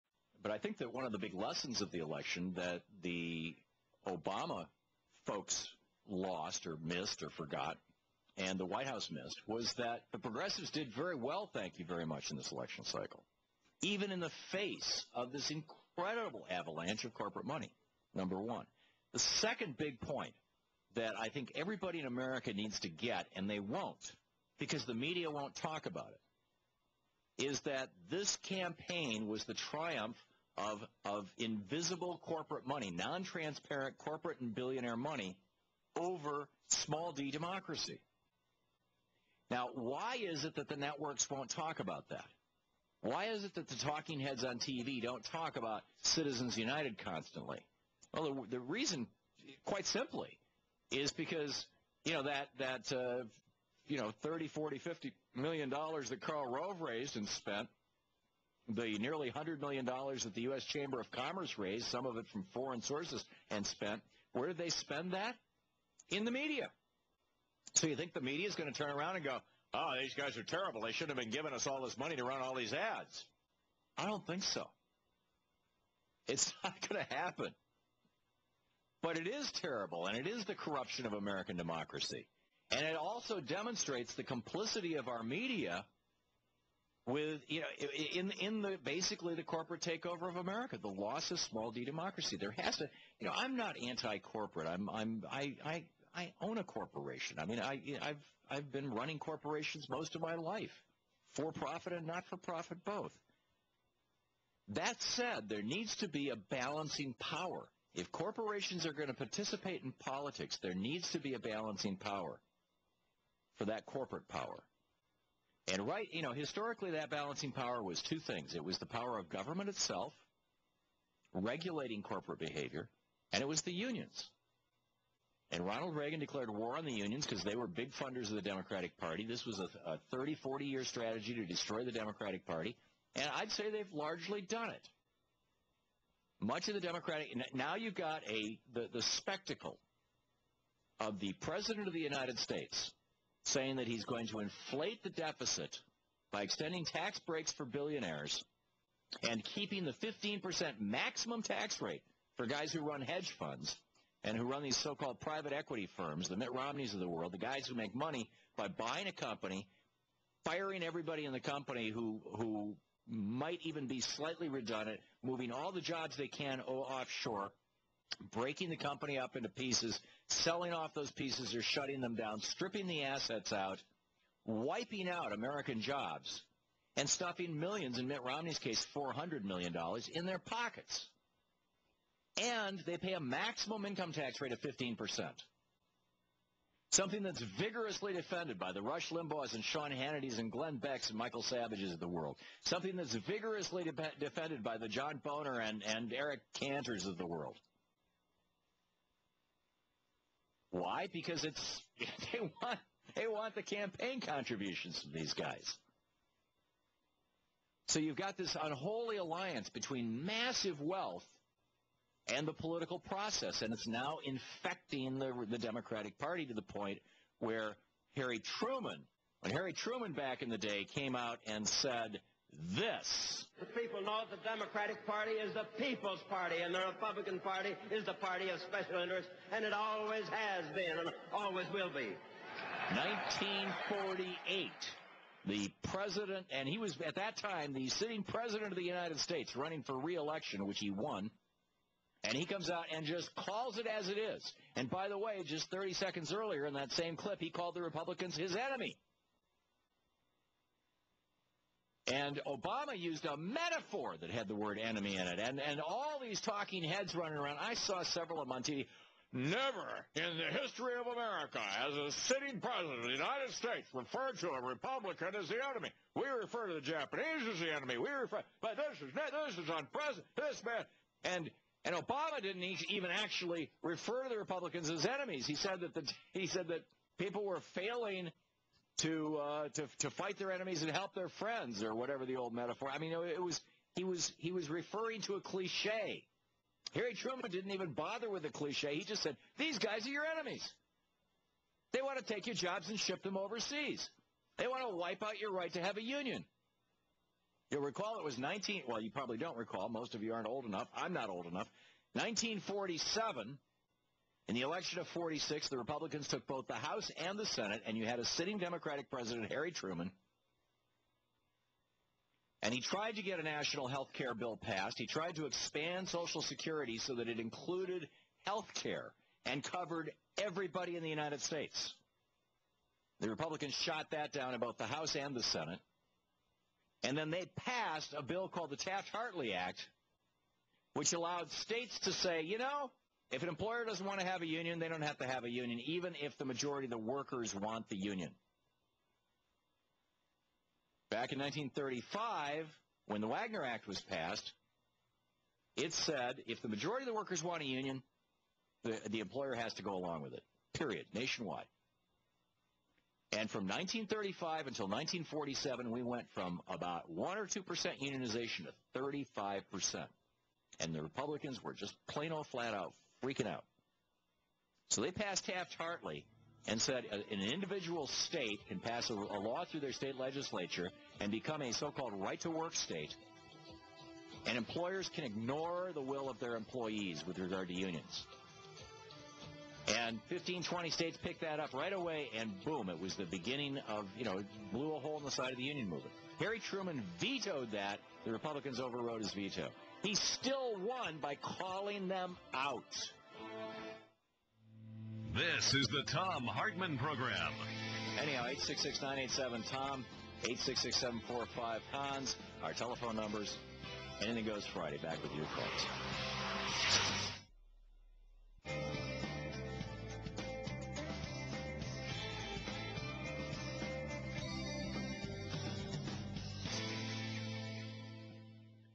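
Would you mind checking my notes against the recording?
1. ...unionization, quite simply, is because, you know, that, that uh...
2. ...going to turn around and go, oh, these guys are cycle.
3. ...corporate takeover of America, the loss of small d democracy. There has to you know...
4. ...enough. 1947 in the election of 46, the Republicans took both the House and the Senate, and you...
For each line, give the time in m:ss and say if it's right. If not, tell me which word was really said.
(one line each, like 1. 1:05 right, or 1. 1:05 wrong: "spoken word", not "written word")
1. 0:48 wrong: "reason", not "unionization"
2. 1:08 wrong: "terrible", not "cycle"
3. 1:29 right
4. 5:01 right.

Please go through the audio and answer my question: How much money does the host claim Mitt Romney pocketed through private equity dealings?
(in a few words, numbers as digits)
$400 million.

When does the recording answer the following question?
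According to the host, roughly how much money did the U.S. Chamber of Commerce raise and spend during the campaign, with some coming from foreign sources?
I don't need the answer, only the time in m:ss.
0:58.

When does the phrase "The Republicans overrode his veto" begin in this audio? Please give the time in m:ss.
6:28.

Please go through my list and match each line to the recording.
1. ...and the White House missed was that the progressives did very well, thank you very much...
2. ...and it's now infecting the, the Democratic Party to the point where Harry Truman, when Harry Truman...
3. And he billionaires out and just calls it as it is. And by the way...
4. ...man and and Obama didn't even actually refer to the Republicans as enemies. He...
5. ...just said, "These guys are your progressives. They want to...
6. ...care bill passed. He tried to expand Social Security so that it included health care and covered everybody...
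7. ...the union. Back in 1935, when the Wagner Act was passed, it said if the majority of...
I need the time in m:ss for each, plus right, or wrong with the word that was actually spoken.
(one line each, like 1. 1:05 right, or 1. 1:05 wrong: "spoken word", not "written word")
1. 0:08 right
2. 3:33 right
3. 4:02 wrong: "comes", not "billionaires"
4. 4:30 right
5. 4:49 wrong: "enemies", not "progressives"
6. 5:14 right
7. 5:37 right.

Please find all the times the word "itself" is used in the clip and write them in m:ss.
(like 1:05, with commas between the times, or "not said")
1:59.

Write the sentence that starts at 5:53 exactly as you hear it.
And from 1935 until 1947, we went from about 1 or 2% unionization to 35%.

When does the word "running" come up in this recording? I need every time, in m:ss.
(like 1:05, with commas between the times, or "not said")
1:38, 3:59, 4:17.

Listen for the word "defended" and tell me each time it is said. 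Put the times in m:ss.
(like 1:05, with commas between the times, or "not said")
3:08, 3:14.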